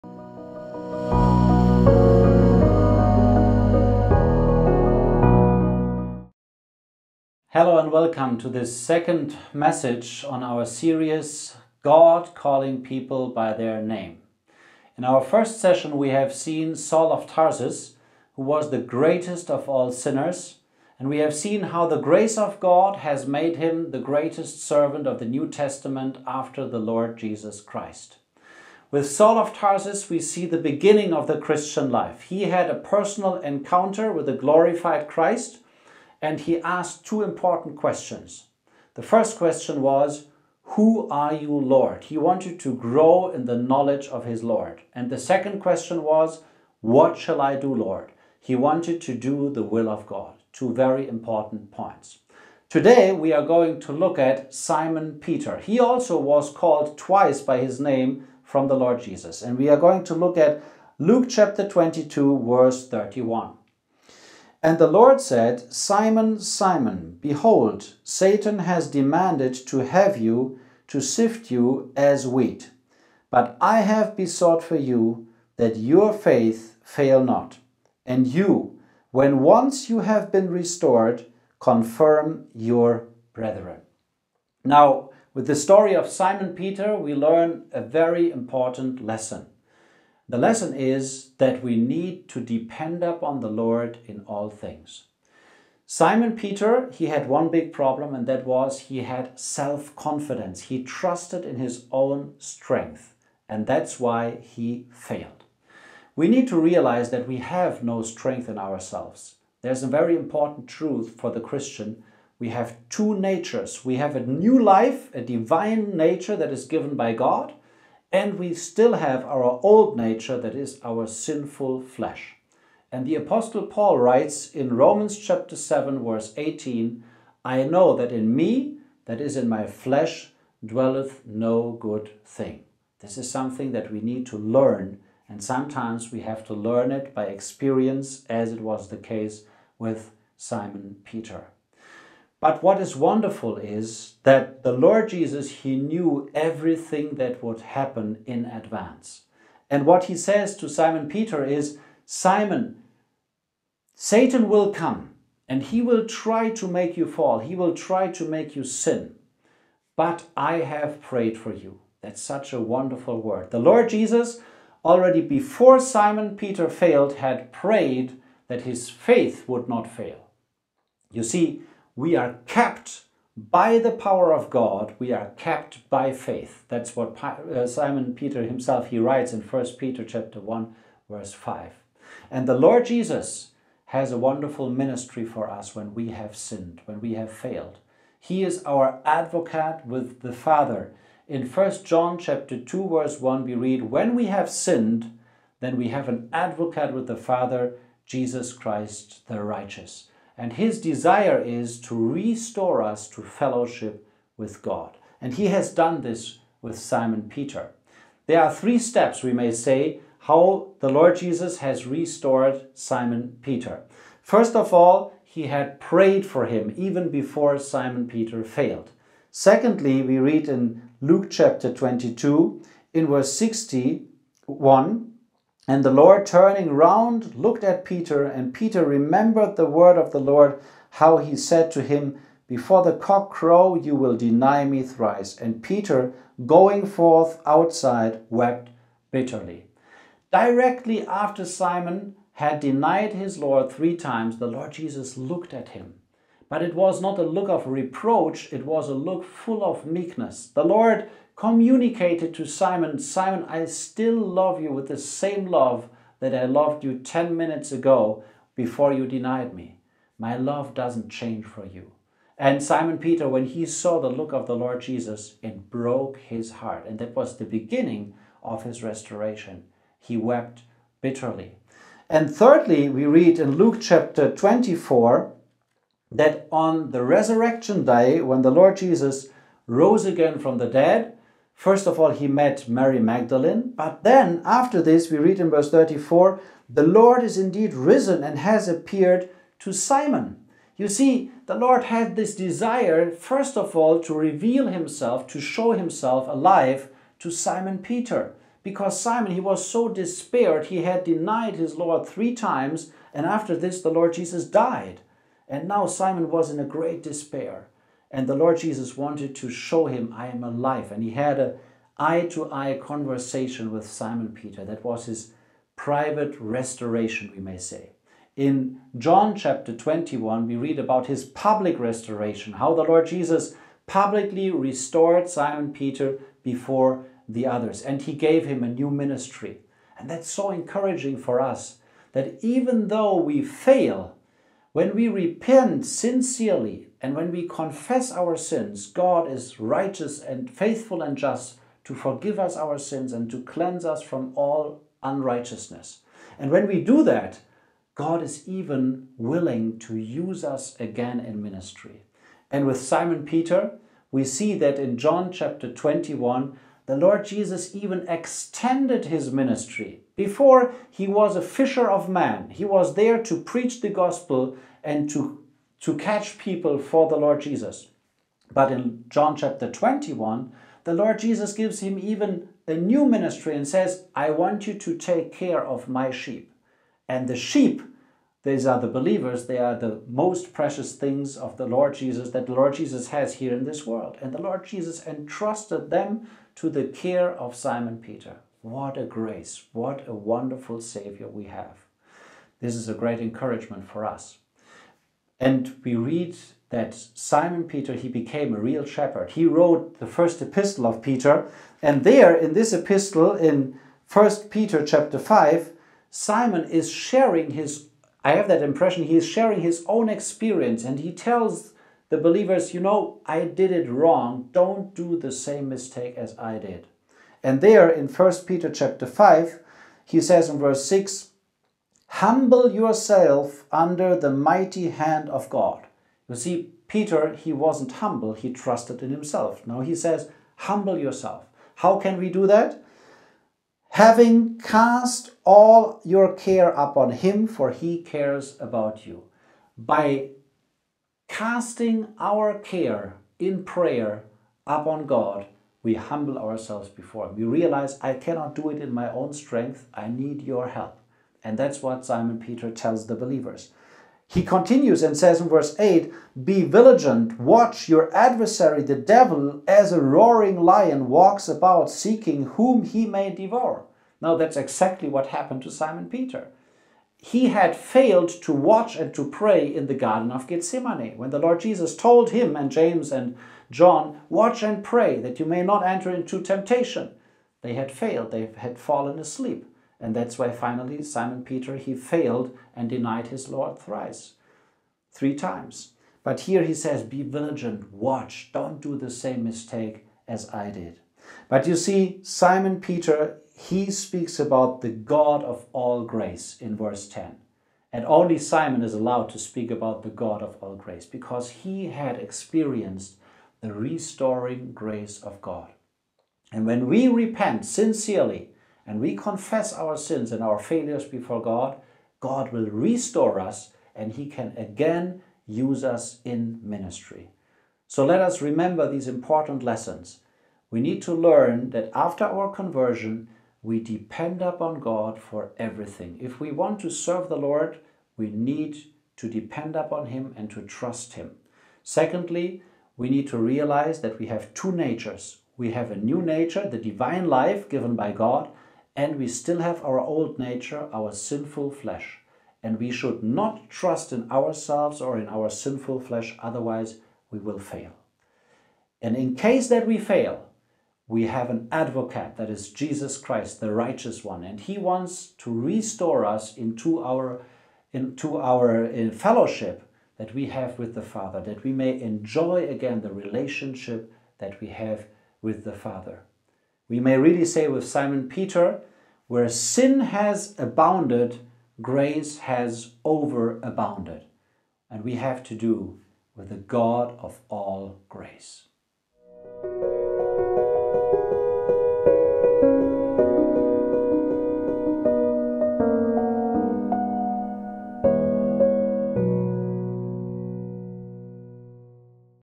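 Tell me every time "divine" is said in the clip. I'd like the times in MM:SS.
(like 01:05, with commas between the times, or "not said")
01:55, 08:56.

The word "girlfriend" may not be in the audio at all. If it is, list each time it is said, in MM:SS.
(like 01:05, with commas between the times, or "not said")
not said.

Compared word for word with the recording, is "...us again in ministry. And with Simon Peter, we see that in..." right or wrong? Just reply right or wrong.
right.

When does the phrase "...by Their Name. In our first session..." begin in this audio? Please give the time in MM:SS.
00:13.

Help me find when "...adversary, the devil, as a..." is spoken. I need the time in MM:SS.
07:38.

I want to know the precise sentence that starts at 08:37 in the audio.
So let us remember these important lessons.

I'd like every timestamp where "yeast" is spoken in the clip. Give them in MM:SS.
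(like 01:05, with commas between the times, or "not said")
not said.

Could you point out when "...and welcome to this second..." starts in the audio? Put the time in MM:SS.
00:07.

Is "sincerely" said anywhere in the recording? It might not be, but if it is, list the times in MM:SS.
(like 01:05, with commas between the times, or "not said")
05:35, 08:27.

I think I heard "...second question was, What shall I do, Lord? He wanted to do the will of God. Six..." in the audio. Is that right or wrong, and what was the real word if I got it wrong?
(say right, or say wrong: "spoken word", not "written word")
wrong: "Two", not "Six".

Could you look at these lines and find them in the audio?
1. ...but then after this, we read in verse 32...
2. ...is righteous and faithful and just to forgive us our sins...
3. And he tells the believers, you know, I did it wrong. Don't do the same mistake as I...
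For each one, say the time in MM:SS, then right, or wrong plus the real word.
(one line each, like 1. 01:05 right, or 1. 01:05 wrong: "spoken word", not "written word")
1. 04:43 wrong: "34", not "32"
2. 05:39 right
3. 06:50 right.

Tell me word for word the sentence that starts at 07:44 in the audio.
Now, that's exactly what happened to Simon Peter.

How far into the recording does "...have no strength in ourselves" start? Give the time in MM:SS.
01:47.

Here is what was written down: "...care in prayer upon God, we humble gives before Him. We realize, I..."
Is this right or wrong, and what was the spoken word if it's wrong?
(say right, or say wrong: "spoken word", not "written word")
wrong: "ourselves", not "gives".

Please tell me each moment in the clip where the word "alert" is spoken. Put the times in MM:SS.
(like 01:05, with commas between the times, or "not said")
not said.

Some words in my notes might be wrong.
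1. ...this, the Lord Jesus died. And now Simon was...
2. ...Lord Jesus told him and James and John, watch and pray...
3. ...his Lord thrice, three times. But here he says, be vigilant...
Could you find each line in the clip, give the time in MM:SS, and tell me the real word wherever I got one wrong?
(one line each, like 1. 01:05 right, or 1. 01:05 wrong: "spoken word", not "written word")
1. 05:03 right
2. 07:51 right
3. 08:03 right.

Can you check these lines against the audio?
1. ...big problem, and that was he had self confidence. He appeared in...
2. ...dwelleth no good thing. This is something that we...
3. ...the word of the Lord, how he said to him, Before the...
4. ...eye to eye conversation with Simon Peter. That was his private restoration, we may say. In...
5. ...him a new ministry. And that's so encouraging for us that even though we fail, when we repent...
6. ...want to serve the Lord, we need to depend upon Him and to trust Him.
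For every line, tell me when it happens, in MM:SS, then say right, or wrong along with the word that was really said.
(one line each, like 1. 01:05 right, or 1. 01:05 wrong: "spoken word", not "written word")
1. 01:37 wrong: "trusted", not "appeared"
2. 02:10 right
3. 03:49 right
4. 05:11 right
5. 05:28 right
6. 08:46 right.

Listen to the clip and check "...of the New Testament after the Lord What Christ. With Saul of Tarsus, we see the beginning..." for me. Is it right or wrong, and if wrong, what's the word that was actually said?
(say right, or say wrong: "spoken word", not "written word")
wrong: "Jesus", not "What".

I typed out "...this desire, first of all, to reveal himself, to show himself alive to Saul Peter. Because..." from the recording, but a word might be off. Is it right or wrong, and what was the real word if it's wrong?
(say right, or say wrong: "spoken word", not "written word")
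wrong: "Simon", not "Saul".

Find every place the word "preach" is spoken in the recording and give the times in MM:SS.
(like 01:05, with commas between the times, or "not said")
06:03.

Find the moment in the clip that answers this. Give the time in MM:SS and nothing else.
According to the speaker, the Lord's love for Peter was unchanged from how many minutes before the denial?
04:16.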